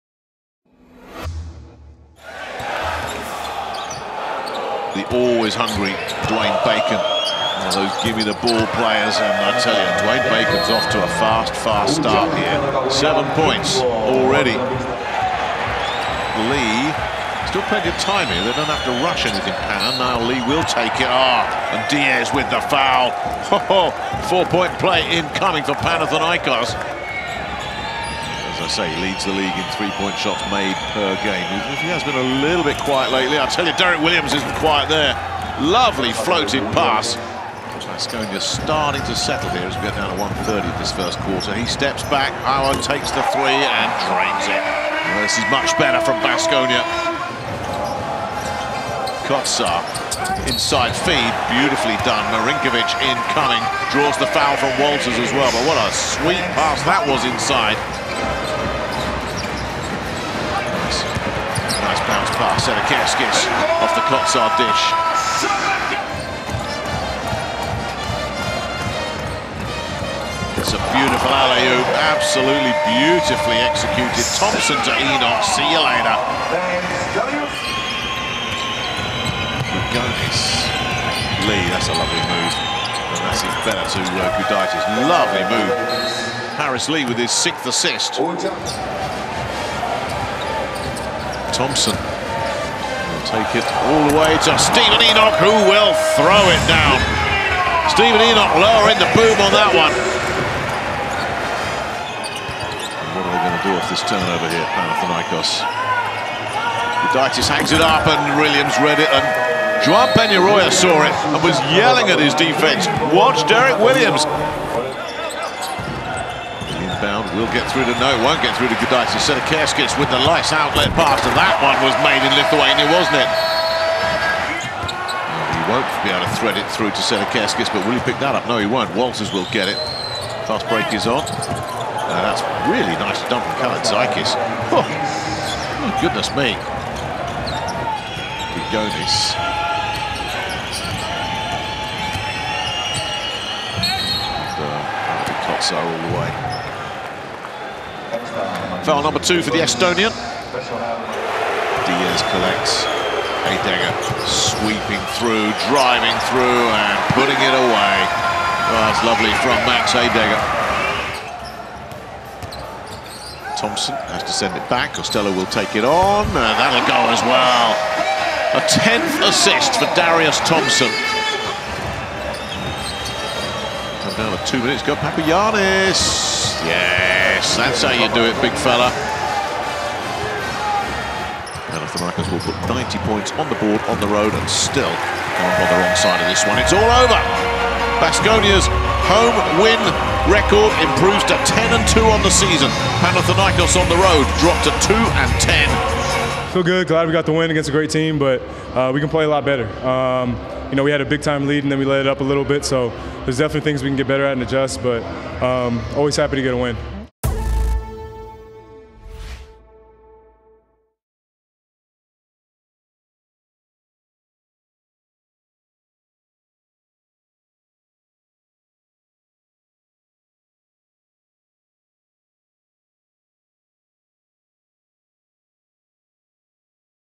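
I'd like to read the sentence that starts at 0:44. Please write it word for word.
Well, this is much better from Baskonia.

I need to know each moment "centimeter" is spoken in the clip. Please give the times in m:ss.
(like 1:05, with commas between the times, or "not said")
not said.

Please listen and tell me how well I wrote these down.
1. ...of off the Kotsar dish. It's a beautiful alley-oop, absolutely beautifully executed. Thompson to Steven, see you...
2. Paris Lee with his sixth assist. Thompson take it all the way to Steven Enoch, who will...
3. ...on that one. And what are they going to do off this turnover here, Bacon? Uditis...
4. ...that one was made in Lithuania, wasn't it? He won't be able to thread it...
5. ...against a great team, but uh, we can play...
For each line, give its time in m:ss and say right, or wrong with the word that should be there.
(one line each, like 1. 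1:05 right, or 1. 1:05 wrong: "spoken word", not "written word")
1. 1:02 wrong: "Enoch", not "Steven"
2. 1:26 right
3. 1:39 wrong: "Panathinaikos", not "Bacon"
4. 2:01 right
5. 3:17 right.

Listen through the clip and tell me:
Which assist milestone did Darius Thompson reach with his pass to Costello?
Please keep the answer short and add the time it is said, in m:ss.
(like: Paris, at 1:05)
10th assist, at 2:48.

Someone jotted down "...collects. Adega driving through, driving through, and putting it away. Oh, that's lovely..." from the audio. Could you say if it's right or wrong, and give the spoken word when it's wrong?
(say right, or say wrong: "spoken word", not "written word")
wrong: "sweeping", not "driving".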